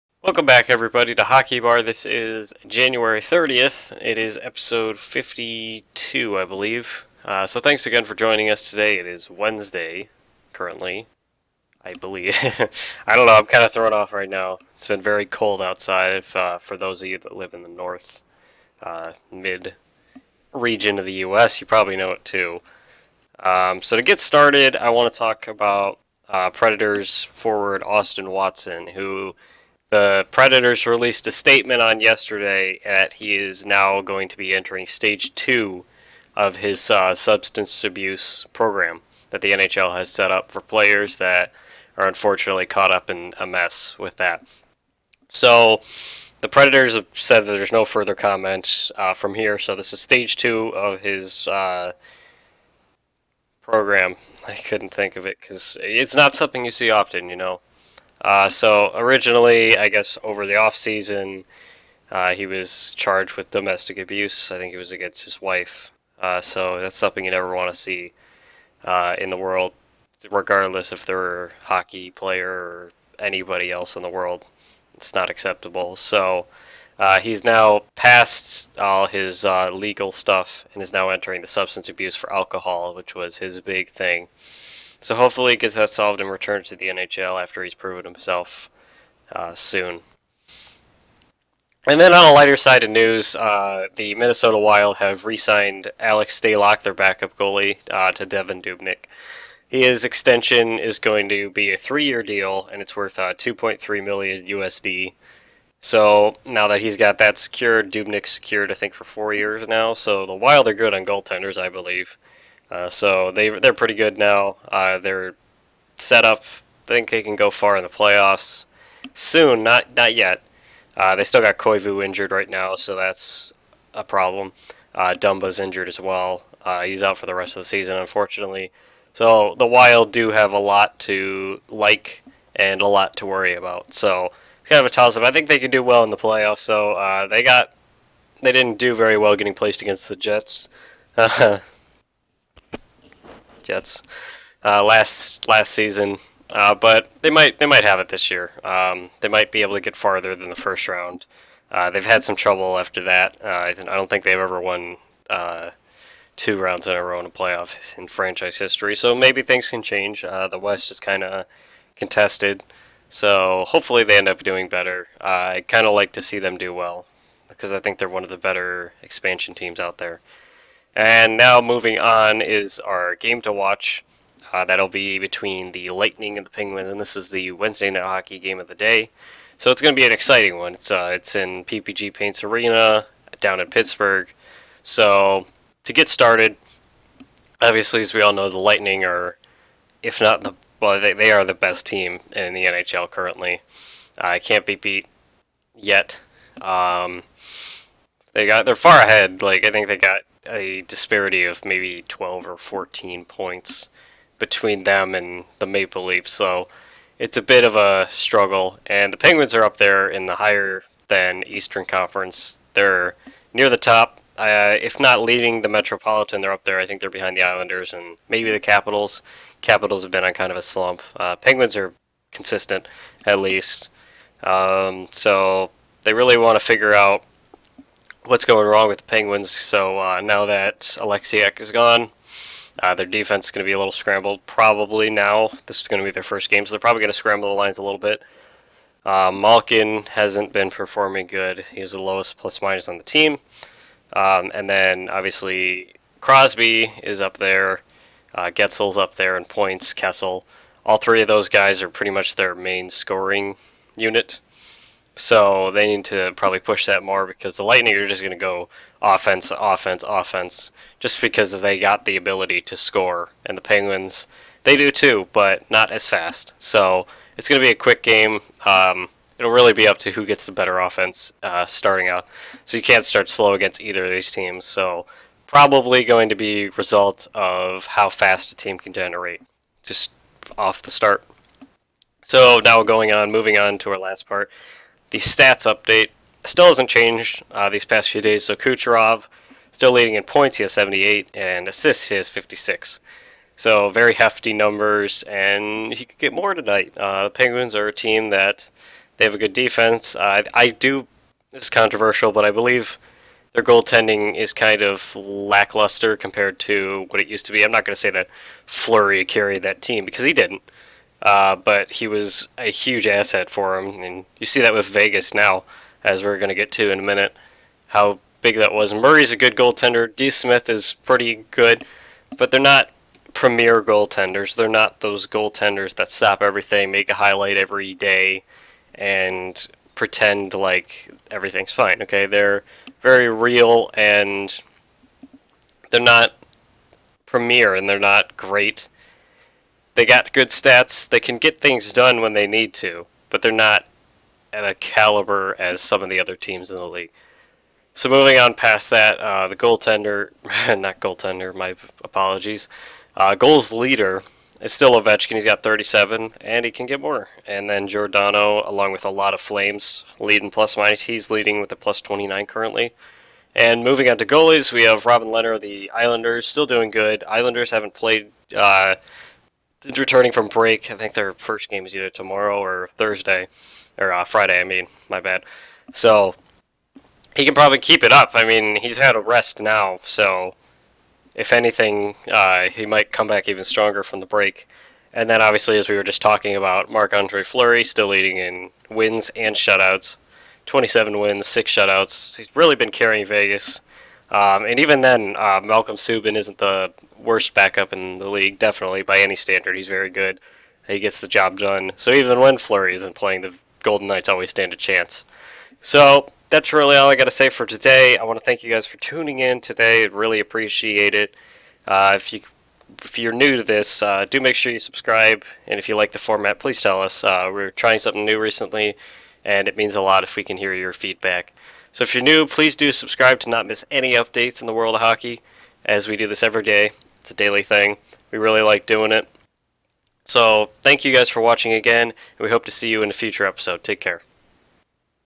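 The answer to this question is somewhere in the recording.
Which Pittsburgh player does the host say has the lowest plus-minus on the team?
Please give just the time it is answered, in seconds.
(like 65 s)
239 s.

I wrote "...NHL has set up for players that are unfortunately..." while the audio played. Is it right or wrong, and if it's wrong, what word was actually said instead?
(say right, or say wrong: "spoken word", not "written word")
right.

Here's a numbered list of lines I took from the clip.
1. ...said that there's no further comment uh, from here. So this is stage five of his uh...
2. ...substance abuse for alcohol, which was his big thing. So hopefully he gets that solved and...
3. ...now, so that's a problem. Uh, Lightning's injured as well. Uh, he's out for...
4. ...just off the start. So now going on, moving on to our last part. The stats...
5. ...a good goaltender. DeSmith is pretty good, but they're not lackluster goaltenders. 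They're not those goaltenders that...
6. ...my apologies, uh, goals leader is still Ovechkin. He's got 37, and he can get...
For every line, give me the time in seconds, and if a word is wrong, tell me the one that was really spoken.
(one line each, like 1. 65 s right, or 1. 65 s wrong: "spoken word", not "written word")
1. 47 s wrong: "two", not "five"
2. 81 s right
3. 122 s wrong: "Dumba", not "Lightning"
4. 279 s right
5. 319 s wrong: "premier", not "lackluster"
6. 351 s right.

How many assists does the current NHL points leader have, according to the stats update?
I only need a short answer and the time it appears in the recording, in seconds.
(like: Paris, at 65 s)
56, at 292 s.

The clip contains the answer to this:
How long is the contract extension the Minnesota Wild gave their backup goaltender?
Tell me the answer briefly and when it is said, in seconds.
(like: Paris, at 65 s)
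3 years, at 101 s.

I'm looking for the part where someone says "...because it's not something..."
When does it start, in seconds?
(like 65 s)
55 s.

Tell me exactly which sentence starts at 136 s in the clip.
So uh, they got they didn't do very well getting placed against the Jets.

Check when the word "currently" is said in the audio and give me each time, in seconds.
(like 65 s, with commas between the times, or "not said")
10 s, 193 s, 362 s.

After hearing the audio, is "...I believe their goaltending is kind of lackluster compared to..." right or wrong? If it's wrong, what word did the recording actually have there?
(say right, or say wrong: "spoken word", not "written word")
right.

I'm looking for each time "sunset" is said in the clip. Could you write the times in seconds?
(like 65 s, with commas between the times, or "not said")
not said.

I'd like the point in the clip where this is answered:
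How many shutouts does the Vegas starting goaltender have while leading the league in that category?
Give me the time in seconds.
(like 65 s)
391 s.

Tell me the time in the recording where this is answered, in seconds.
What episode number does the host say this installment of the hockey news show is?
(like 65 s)
4 s.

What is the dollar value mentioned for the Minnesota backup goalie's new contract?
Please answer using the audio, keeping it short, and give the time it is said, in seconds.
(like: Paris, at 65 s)
2.3 million USD, at 103 s.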